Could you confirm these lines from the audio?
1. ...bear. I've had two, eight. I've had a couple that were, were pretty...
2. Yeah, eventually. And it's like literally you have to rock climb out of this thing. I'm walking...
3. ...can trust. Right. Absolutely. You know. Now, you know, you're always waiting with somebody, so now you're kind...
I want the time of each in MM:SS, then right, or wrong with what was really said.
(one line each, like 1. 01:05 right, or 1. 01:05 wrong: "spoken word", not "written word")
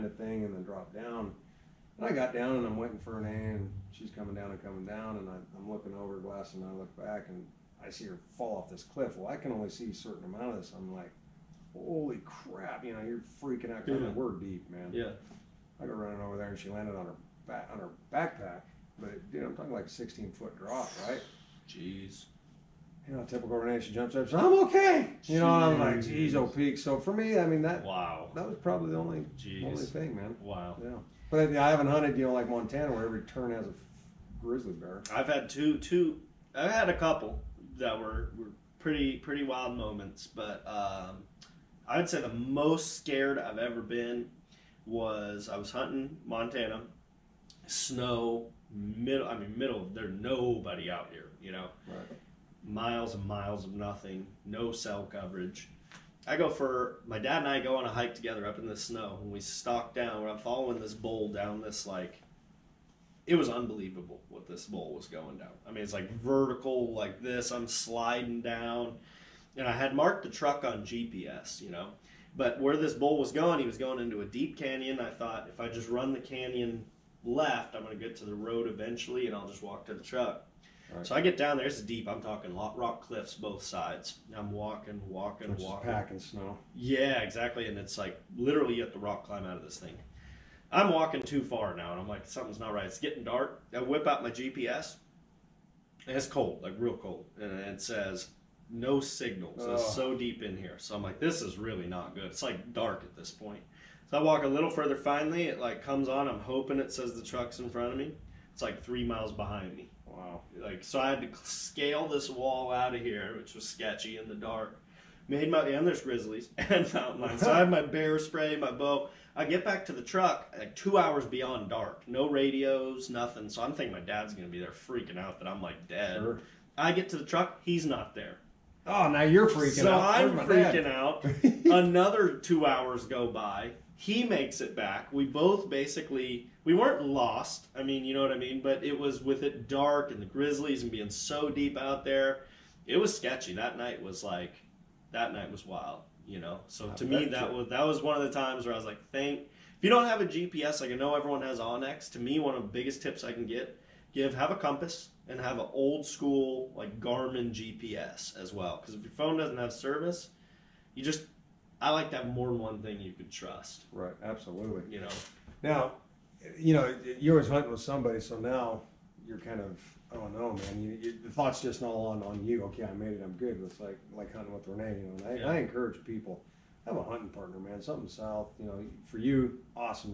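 1. 00:34 wrong: "two", not "eight"
2. 01:26 wrong: "exactly", not "eventually"
3. 02:43 wrong: "hunting", not "waiting".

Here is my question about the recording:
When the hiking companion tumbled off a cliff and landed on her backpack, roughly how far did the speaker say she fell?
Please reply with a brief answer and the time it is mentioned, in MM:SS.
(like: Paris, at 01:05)
16 foot, at 00:19.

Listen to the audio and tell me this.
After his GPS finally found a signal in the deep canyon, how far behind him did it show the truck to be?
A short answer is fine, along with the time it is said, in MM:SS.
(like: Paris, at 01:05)
3 miles, at 01:48.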